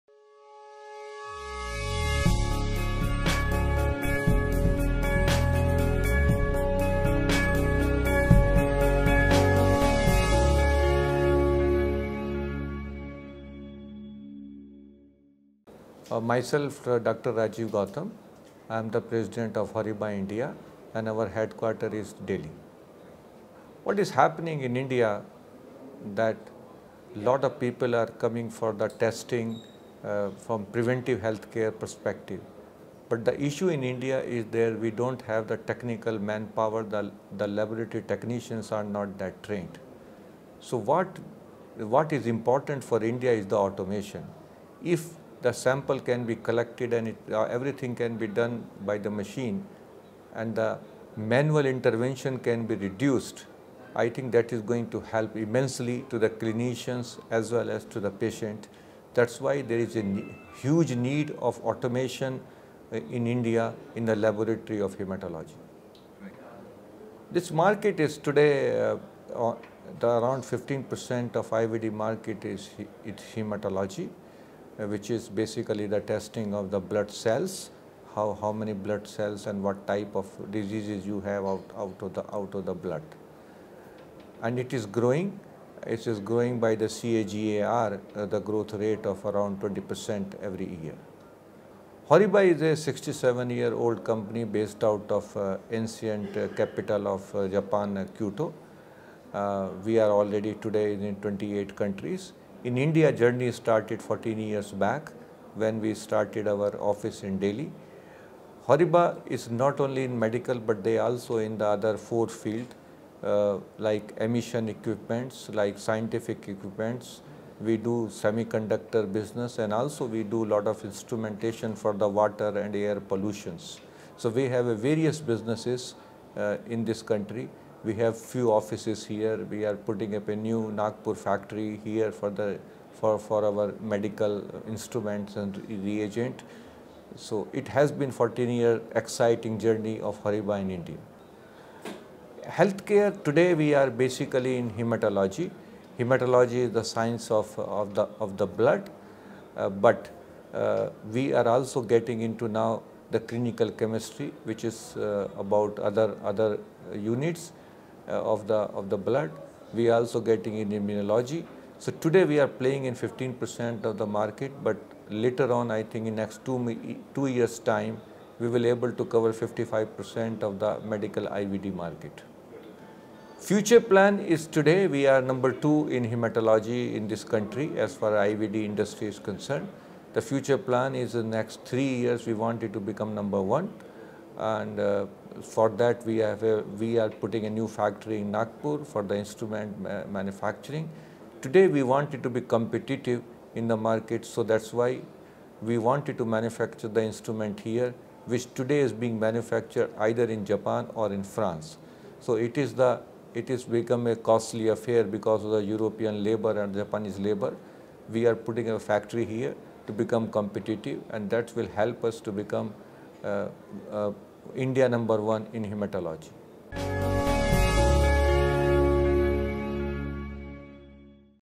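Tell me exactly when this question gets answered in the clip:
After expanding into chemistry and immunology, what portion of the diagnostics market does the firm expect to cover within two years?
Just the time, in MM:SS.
02:49.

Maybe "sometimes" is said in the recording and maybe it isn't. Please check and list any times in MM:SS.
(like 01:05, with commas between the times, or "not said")
not said.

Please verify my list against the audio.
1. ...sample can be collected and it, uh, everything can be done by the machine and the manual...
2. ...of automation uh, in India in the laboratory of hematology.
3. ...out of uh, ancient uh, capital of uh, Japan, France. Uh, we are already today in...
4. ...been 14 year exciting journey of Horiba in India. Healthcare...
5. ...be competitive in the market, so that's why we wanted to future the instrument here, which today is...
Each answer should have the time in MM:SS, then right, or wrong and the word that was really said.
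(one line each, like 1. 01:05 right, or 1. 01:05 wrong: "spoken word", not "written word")
1. 00:45 right
2. 01:01 right
3. 01:34 wrong: "Kyoto", not "France"
4. 02:17 right
5. 03:12 wrong: "manufacture", not "future".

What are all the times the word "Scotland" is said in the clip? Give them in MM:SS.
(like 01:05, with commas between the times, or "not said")
not said.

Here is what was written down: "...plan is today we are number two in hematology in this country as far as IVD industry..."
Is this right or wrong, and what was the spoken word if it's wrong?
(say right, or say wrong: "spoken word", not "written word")
right.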